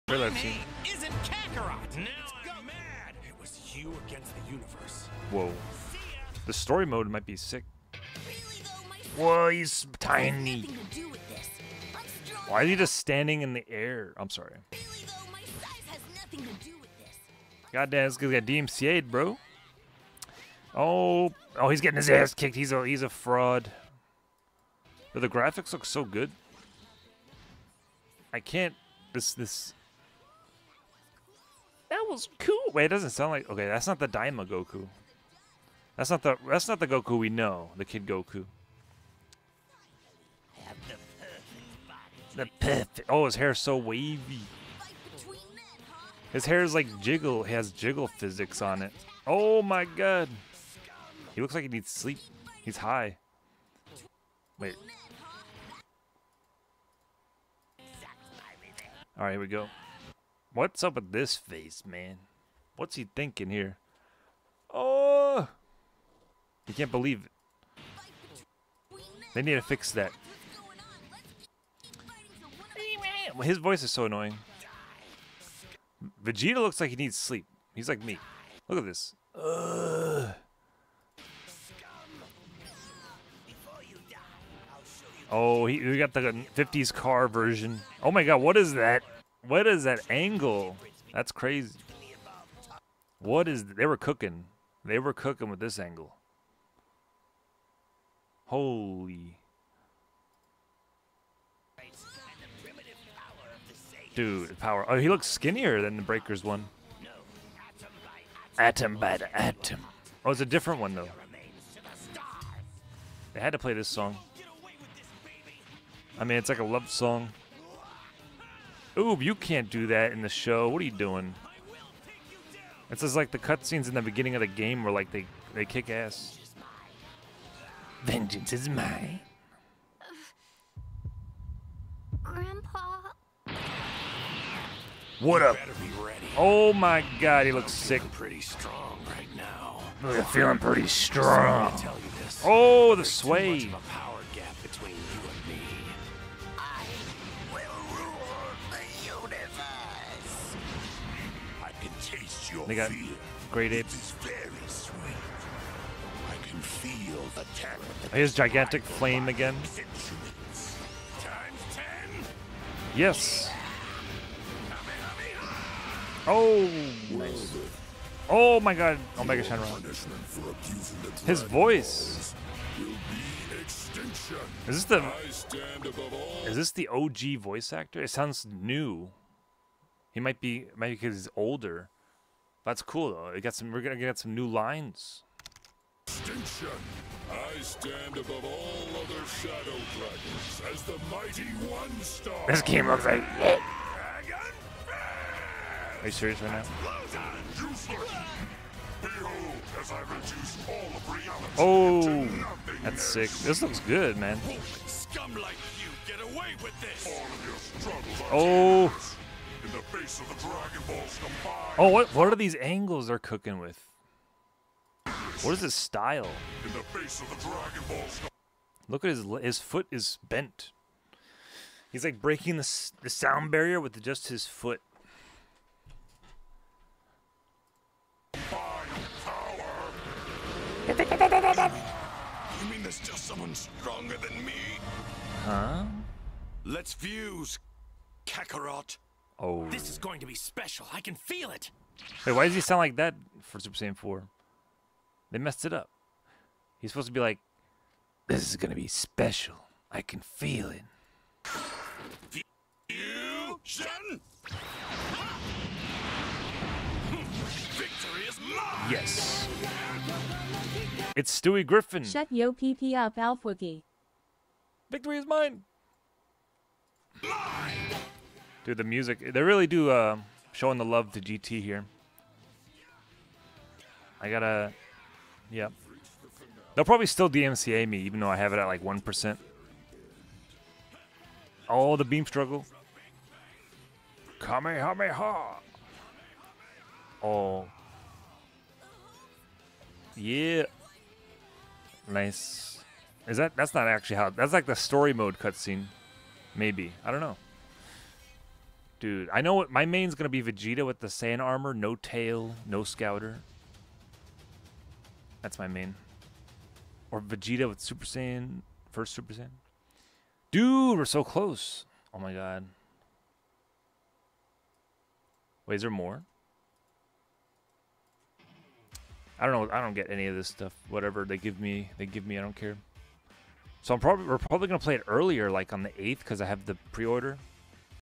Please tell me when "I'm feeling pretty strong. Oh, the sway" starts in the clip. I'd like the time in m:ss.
2:20.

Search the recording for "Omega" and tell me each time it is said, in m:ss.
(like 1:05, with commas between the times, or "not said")
2:49.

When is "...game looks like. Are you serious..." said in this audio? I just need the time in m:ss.
3:12.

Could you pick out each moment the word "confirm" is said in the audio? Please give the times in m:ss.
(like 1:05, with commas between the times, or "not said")
not said.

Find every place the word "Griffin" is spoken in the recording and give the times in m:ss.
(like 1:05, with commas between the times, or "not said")
4:21.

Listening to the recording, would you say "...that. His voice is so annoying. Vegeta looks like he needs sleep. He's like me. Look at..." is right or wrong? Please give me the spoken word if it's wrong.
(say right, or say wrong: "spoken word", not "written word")
right.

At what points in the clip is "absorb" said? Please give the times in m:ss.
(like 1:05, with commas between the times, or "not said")
not said.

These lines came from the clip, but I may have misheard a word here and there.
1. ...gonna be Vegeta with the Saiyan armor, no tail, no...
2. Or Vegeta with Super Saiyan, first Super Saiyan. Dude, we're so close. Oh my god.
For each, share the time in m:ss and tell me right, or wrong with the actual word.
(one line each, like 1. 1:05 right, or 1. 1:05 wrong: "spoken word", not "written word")
1. 5:00 right
2. 5:07 right.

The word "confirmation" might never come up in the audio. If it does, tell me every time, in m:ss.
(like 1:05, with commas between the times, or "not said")
not said.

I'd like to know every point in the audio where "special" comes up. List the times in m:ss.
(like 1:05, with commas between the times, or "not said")
4:00, 4:08.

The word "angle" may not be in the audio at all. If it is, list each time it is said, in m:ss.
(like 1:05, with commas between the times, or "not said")
1:30, 1:35, 3:32.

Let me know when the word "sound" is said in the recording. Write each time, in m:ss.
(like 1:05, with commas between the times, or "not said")
0:33, 2:58, 3:43, 4:02.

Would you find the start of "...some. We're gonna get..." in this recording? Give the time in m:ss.
3:03.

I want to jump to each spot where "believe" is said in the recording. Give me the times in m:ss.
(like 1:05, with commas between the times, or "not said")
1:06.